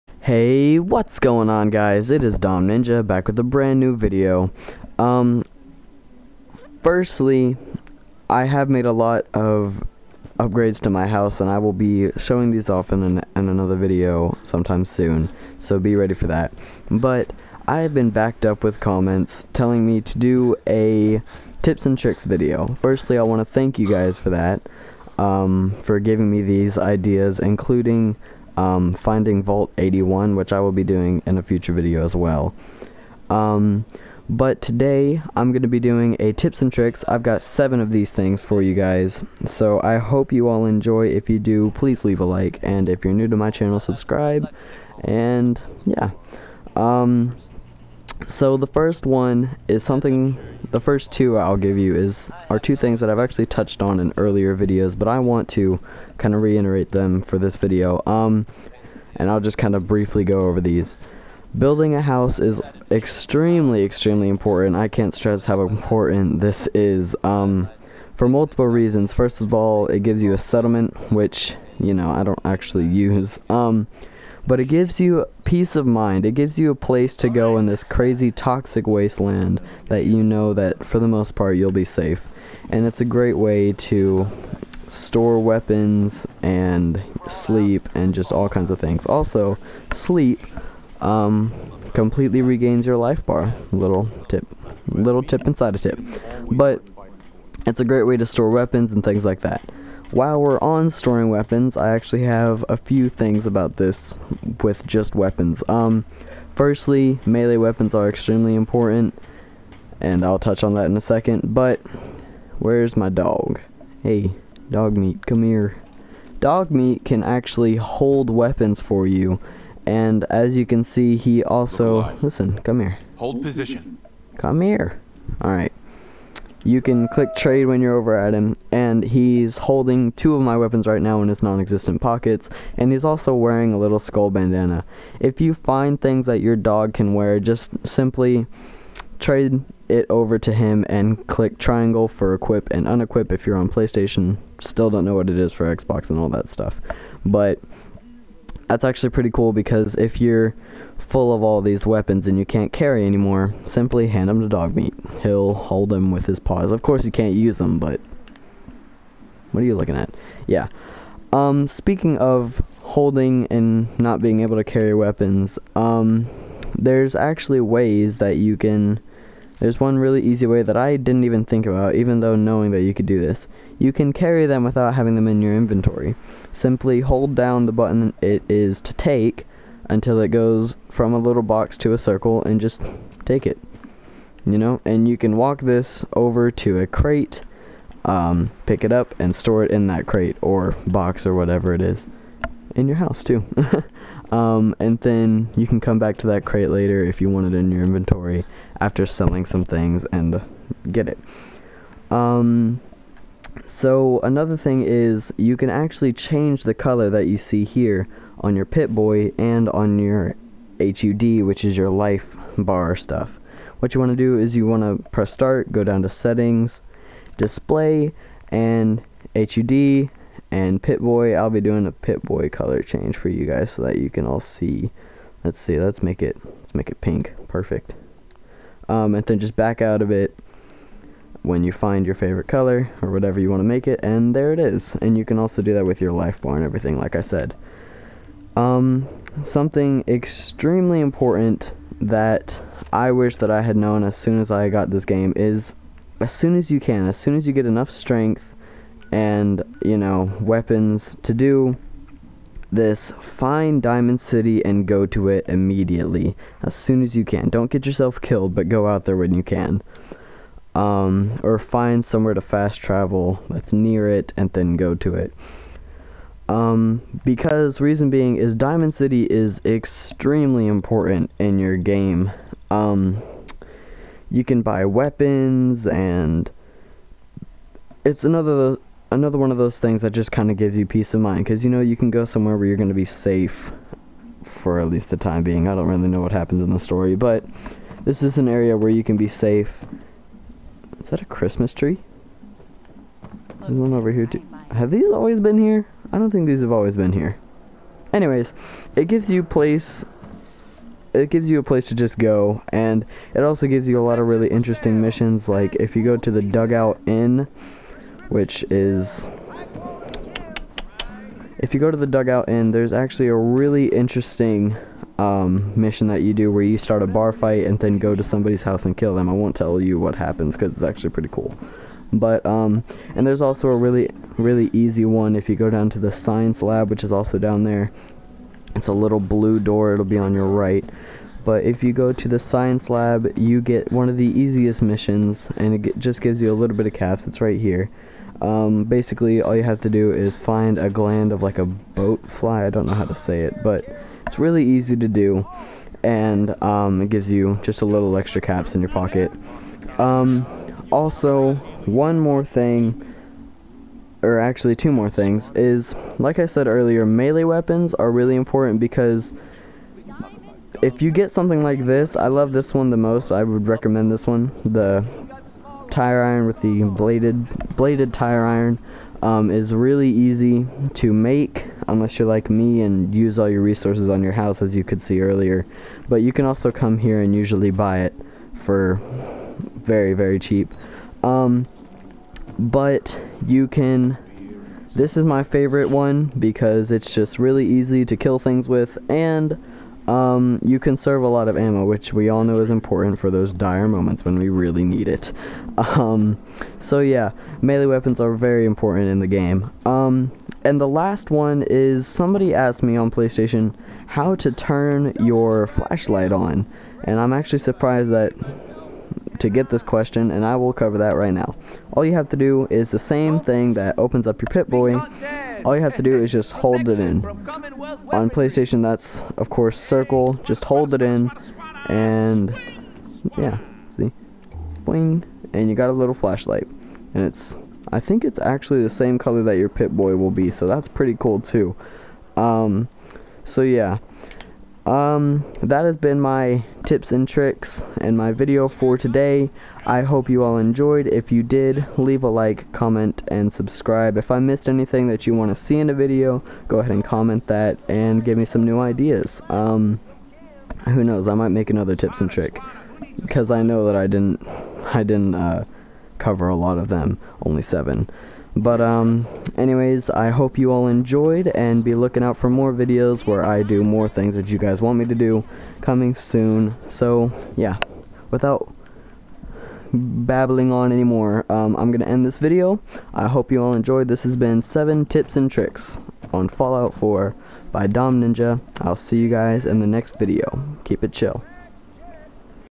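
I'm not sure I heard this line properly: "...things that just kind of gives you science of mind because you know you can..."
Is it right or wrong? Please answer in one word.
wrong.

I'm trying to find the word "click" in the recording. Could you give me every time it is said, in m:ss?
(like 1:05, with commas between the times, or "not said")
2:07, 2:21.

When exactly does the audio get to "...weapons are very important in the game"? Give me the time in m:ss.
6:37.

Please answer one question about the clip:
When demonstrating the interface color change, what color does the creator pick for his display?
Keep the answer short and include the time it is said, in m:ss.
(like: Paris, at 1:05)
pink, at 3:47.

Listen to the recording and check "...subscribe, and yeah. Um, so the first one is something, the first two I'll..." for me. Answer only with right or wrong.
right.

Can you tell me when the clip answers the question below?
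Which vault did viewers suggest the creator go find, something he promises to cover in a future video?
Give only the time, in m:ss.
0:29.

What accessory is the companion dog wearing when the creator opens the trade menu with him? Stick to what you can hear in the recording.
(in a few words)
skull bandana.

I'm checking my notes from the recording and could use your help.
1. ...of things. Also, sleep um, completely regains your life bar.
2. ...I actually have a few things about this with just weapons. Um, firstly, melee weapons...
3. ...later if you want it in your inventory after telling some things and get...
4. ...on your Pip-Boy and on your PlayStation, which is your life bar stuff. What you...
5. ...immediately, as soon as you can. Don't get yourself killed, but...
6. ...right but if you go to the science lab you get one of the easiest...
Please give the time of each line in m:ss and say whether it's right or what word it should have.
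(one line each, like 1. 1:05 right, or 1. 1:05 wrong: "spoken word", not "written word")
1. 1:28 right
2. 1:41 right
3. 3:16 wrong: "selling", not "telling"
4. 3:28 wrong: "HUD", not "PlayStation"
5. 4:15 right
6. 5:30 right.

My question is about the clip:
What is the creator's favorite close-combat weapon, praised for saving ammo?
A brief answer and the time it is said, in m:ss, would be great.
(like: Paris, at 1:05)
bladed tire iron, at 6:07.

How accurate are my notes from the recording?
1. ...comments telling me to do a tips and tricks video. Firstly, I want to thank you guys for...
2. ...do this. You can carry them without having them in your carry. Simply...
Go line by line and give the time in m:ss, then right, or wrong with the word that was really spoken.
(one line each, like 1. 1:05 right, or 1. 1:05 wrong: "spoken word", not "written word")
1. 0:18 right
2. 2:53 wrong: "inventory", not "carry".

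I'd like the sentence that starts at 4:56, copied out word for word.
I don't think these have always been here.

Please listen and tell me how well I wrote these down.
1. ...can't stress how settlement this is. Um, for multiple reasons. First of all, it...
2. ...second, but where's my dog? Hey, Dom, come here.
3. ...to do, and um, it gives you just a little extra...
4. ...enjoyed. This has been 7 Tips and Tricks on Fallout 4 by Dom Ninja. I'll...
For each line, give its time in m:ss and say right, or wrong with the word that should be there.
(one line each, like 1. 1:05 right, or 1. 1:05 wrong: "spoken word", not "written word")
1. 1:04 wrong: "important", not "settlement"
2. 1:51 wrong: "Dogmeat", not "Dom"
3. 5:44 right
4. 7:53 right.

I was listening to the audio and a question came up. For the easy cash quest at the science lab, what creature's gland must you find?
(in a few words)
bloatfly.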